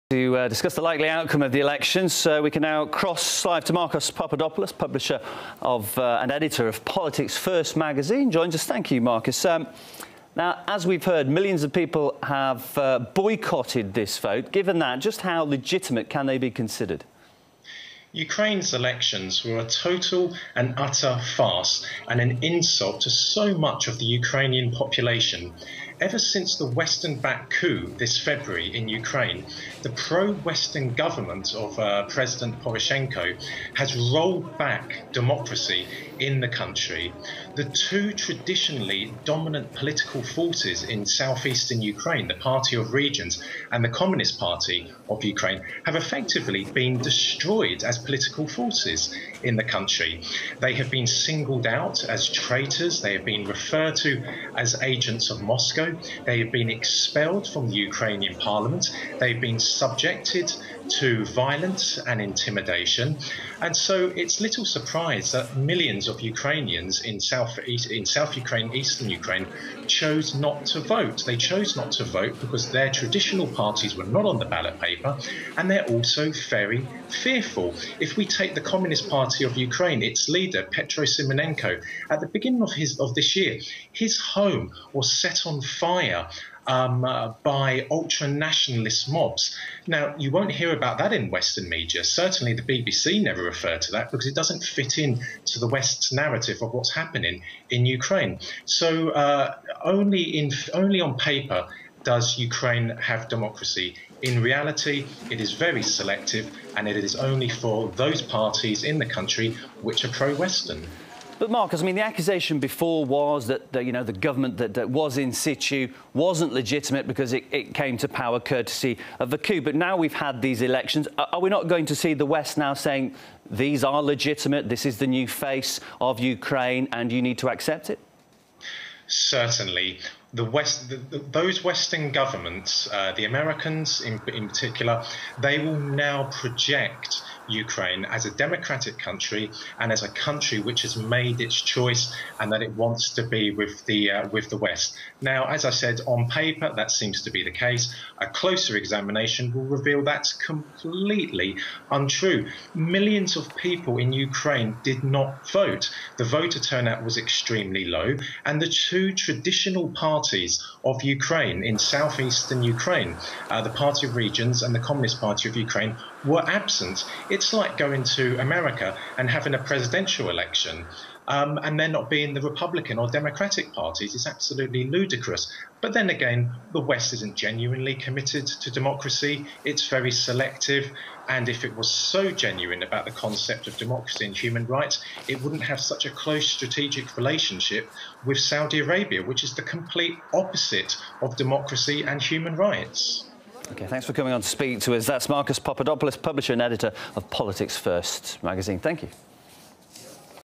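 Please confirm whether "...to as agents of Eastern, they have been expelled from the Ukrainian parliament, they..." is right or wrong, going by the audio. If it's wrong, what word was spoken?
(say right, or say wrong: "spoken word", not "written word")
wrong: "Moscow", not "Eastern".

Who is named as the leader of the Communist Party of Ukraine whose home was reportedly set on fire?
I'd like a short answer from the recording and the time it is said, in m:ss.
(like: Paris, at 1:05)
Petro Simonenko, at 1:20.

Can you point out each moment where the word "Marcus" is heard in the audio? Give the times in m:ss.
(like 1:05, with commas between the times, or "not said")
0:03, 0:08, 1:51, 3:15.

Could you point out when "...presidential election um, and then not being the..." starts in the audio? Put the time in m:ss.
2:49.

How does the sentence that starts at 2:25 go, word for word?
Now, as I said, on paper that seems to be the case.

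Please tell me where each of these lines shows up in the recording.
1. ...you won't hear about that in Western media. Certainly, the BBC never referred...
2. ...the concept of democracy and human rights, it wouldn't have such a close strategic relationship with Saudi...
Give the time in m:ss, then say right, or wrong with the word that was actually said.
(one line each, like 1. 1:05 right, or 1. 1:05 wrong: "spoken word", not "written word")
1. 1:30 right
2. 3:03 right.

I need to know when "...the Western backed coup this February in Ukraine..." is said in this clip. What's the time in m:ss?
0:26.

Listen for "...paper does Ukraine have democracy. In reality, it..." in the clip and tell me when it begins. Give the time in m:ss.
1:41.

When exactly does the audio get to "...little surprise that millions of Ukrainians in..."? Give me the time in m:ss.
1:04.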